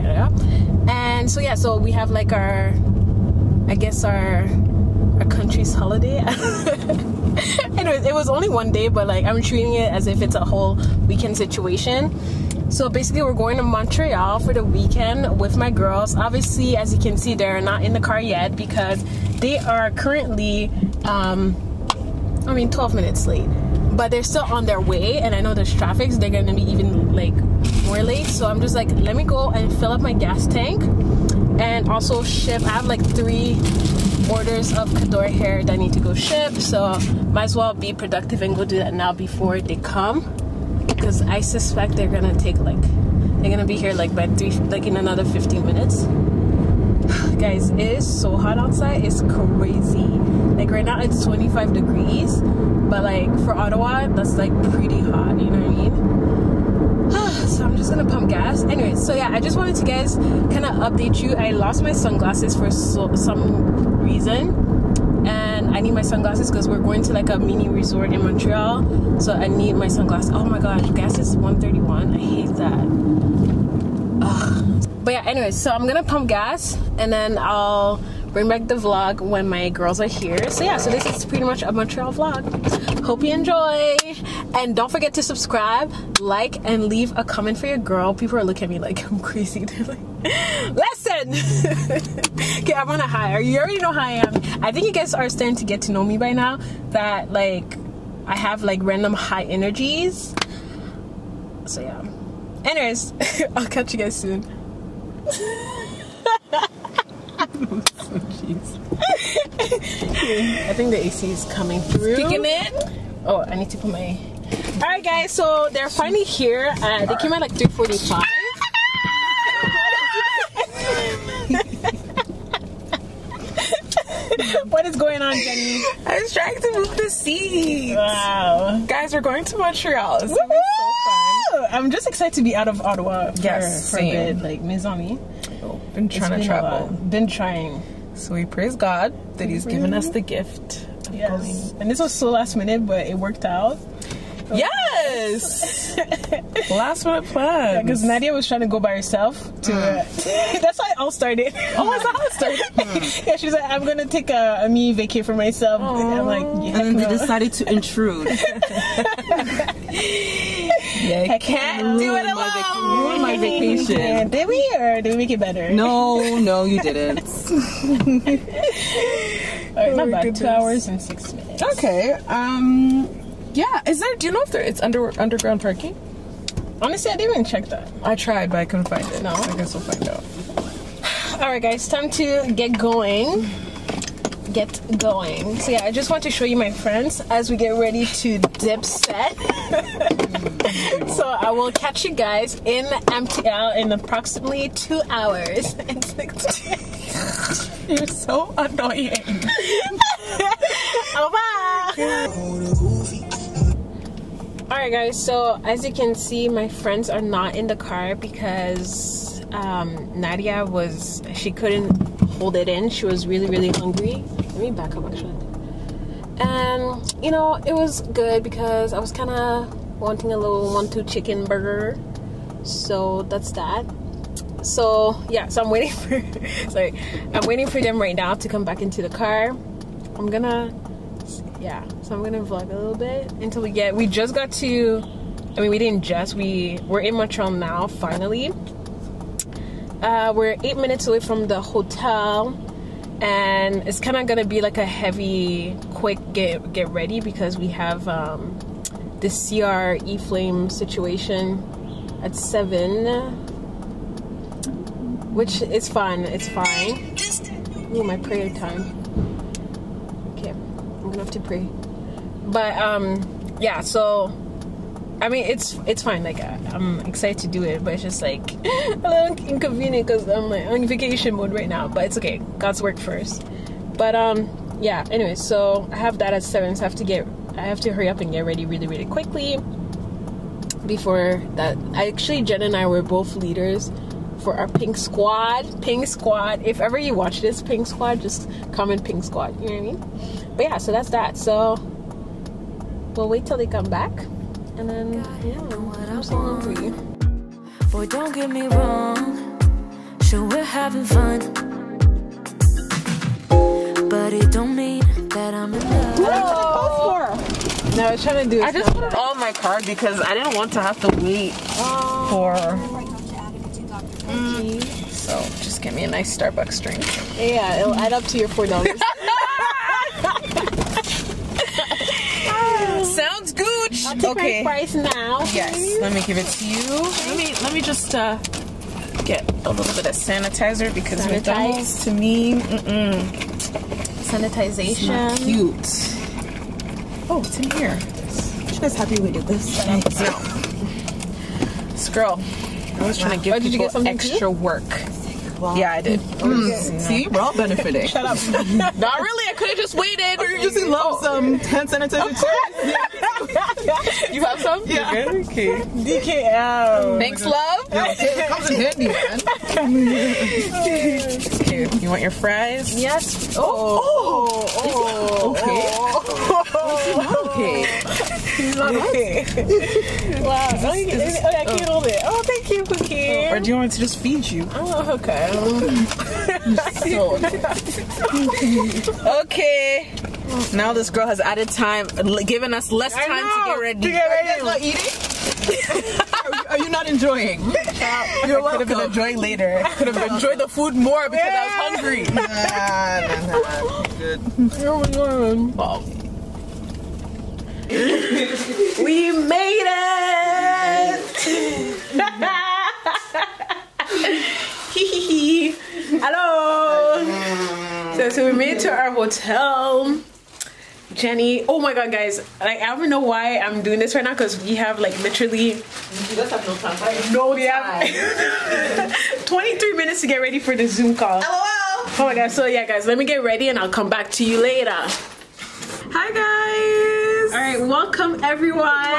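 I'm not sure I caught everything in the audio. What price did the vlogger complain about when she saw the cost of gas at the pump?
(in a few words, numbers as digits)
131.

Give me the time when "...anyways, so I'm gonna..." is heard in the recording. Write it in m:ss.
1:15.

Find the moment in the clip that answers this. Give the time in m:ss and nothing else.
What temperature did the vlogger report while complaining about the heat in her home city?
0:51.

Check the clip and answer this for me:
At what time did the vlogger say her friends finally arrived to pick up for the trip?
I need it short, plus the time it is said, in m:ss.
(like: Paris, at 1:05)
3:45, at 1:57.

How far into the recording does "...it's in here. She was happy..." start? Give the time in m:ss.
5:37.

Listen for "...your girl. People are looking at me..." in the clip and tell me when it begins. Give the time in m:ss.
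1:27.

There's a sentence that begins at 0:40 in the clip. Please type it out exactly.
Because I suspect they're gonna take like they're gonna be here like by three like in another 15 minutes.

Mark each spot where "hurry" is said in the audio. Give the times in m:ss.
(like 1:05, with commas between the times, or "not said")
4:37.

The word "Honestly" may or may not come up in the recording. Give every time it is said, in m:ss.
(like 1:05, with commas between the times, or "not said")
2:56.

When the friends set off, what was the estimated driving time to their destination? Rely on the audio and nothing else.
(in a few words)
2 hours and 6 minutes.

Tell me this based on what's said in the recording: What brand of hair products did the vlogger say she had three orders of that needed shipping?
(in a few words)
Kadore hair.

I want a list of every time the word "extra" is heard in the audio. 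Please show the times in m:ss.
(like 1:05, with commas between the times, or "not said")
5:44.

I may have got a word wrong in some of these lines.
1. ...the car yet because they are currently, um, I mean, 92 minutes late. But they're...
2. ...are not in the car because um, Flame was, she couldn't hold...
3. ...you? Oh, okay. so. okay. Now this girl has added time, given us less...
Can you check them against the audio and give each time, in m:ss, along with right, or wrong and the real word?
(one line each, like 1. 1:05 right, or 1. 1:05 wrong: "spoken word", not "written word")
1. 0:17 wrong: "12", not "92"
2. 3:27 wrong: "Nadia", not "Flame"
3. 6:14 right.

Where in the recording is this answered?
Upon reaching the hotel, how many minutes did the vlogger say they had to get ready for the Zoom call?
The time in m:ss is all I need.
6:59.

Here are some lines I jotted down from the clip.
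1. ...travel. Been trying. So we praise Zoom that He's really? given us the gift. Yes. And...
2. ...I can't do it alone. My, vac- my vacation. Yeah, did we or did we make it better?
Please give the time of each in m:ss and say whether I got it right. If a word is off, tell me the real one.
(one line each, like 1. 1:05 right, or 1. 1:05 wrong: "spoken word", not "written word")
1. 2:16 wrong: "God", not "Zoom"
2. 2:41 right.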